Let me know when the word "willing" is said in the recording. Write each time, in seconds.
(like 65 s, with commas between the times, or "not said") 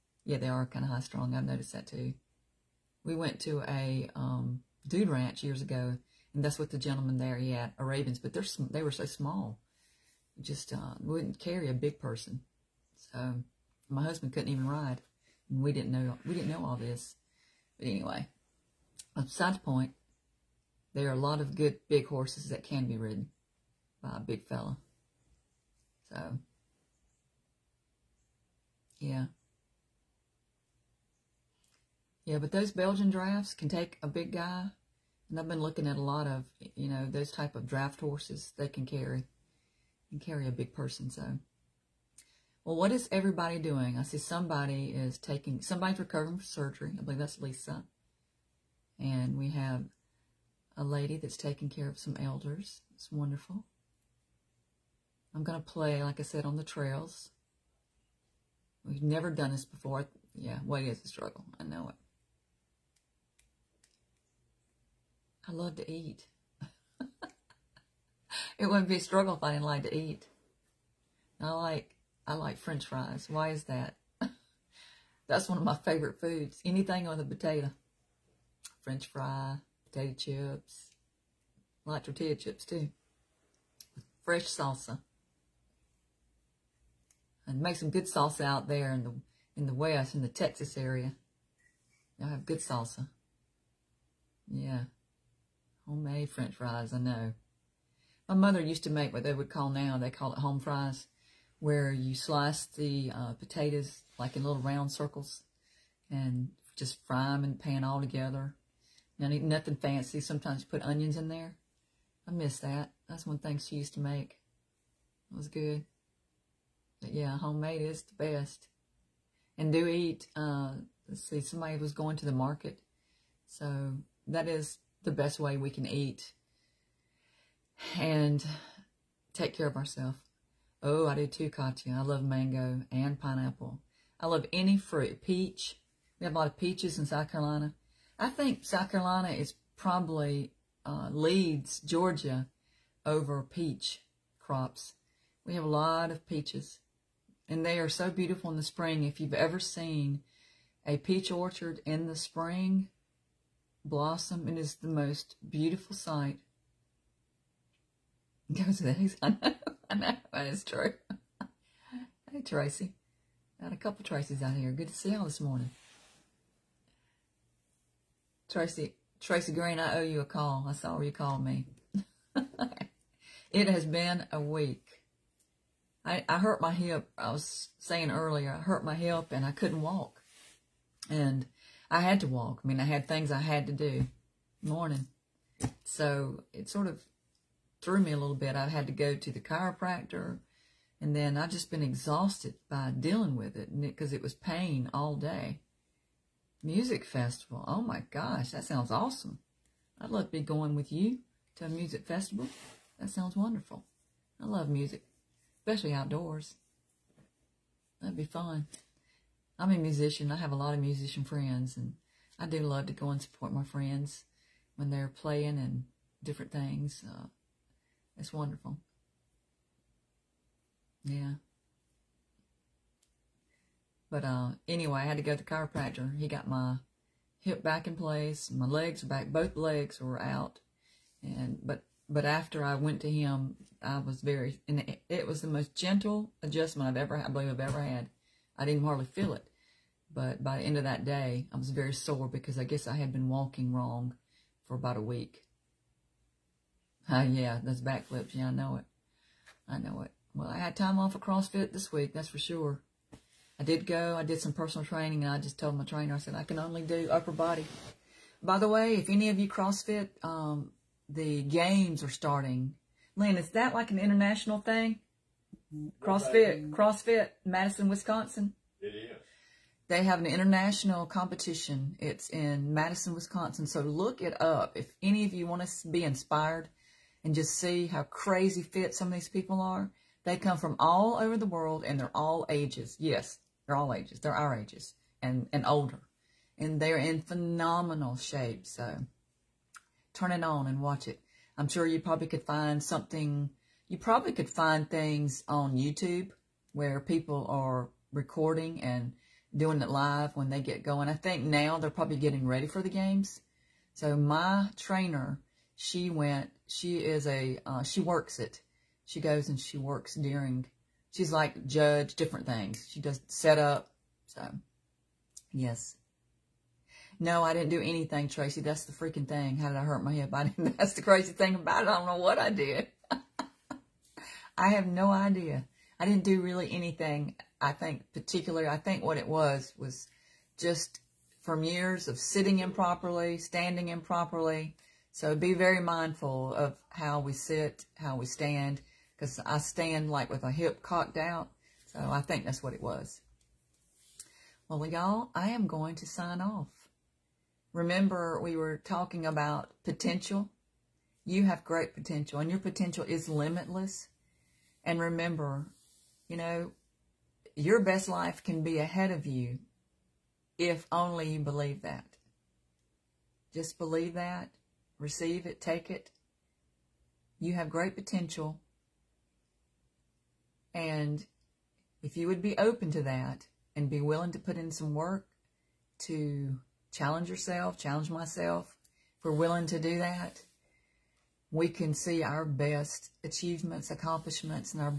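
373 s, 379 s.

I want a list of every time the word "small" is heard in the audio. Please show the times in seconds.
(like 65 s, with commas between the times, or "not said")
9 s.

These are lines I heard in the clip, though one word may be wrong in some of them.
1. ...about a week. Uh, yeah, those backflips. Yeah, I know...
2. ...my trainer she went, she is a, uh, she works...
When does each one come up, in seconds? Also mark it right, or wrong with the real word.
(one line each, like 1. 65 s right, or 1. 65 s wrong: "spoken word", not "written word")
1. 244 s right
2. 304 s right.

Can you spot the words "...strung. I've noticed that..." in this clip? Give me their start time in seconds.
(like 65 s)
0 s.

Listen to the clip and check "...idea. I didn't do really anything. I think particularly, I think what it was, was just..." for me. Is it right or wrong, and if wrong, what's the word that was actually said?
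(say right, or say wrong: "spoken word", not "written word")
right.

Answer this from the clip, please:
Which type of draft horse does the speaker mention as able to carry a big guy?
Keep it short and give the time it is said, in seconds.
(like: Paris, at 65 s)
Belgian, at 32 s.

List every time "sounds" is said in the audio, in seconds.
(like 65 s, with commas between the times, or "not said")
198 s, 203 s.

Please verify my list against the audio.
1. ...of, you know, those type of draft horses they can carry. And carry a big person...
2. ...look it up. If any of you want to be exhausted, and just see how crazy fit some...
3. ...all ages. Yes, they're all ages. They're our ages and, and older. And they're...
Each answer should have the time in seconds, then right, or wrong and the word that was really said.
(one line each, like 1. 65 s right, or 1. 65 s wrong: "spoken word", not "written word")
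1. 36 s right
2. 273 s wrong: "inspired", not "exhausted"
3. 282 s right.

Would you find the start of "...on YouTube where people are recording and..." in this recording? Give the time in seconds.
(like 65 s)
295 s.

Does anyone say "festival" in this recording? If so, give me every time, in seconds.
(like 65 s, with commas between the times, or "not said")
197 s, 202 s.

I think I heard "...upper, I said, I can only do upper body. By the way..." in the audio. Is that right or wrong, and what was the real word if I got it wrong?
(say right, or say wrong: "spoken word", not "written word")
wrong: "trainer", not "upper".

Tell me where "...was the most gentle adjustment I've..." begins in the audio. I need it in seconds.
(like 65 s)
235 s.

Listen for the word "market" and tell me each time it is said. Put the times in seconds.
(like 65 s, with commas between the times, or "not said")
122 s.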